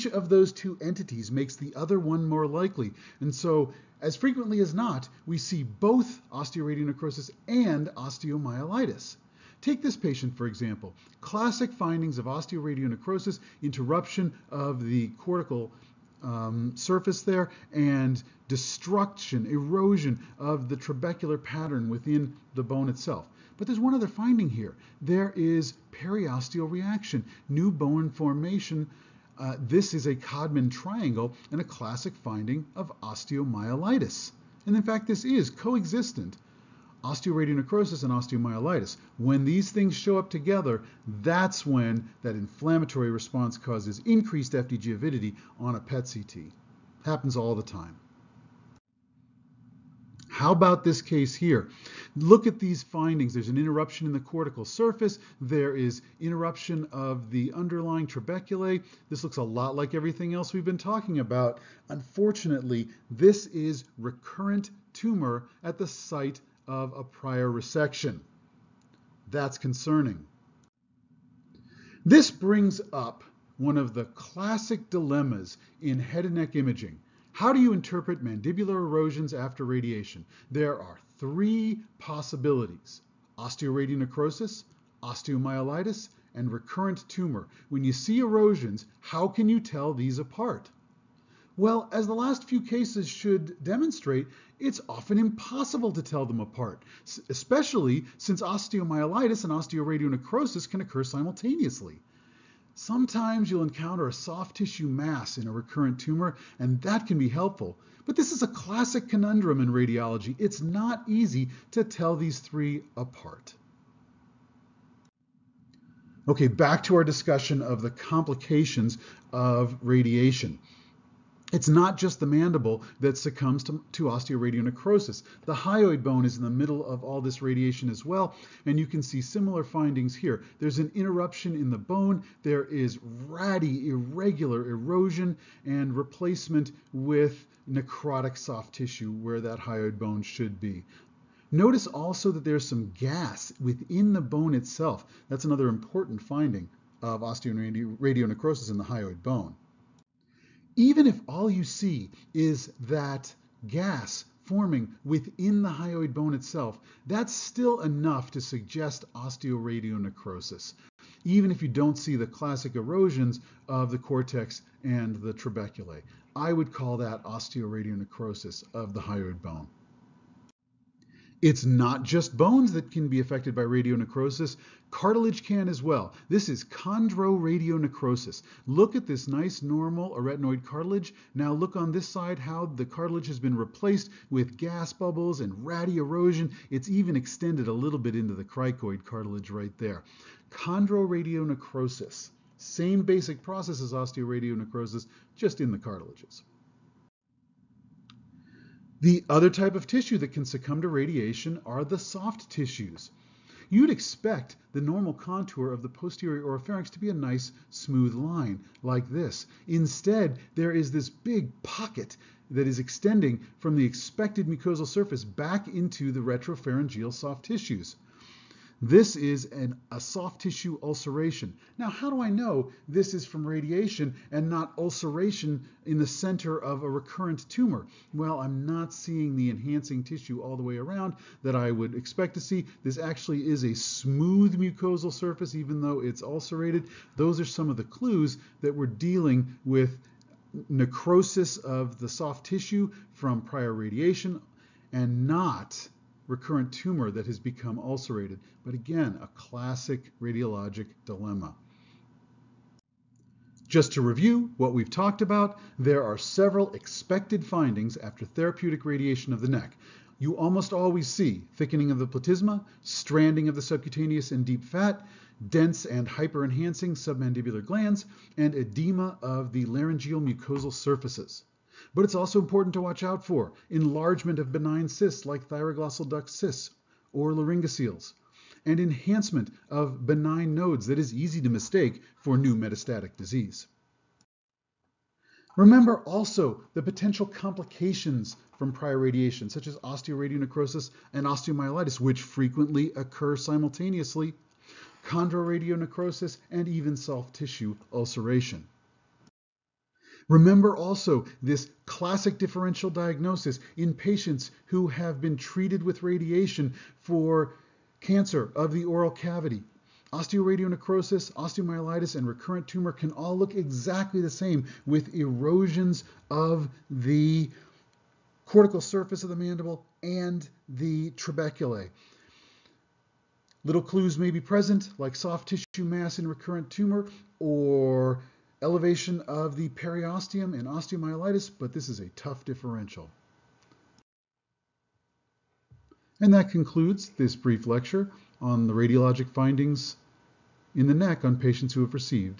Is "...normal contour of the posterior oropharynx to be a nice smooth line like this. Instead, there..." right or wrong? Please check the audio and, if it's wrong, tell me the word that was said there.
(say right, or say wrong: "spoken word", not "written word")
right.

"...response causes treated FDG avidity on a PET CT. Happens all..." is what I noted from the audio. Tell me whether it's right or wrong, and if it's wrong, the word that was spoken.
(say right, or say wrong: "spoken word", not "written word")
wrong: "increased", not "treated".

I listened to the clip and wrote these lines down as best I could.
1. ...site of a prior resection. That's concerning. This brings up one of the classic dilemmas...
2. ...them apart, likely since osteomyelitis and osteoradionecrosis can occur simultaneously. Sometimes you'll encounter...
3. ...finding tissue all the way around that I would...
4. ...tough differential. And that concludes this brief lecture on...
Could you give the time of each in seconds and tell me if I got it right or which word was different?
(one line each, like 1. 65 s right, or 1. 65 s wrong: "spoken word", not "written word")
1. 65 s right
2. 96 s wrong: "especially", not "likely"
3. 229 s wrong: "enhancing", not "finding"
4. 332 s right.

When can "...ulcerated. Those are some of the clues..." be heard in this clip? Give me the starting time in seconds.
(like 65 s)
236 s.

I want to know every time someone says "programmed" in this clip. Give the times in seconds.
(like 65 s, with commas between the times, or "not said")
not said.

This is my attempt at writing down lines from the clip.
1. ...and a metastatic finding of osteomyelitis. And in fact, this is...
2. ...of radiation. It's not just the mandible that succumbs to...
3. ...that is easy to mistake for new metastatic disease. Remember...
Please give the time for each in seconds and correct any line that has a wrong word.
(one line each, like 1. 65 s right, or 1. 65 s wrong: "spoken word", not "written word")
1. 31 s wrong: "classic", not "metastatic"
2. 119 s right
3. 280 s right.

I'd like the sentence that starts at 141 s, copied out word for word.
Notice also that there's some gas within the bone itself.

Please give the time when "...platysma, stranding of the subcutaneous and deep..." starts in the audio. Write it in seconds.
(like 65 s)
262 s.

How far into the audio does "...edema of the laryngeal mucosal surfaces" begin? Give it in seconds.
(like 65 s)
268 s.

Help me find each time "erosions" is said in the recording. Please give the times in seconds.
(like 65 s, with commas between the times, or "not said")
19 s, 78 s, 88 s, 134 s, 162 s, 185 s, 315 s.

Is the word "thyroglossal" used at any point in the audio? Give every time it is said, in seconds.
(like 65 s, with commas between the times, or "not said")
275 s.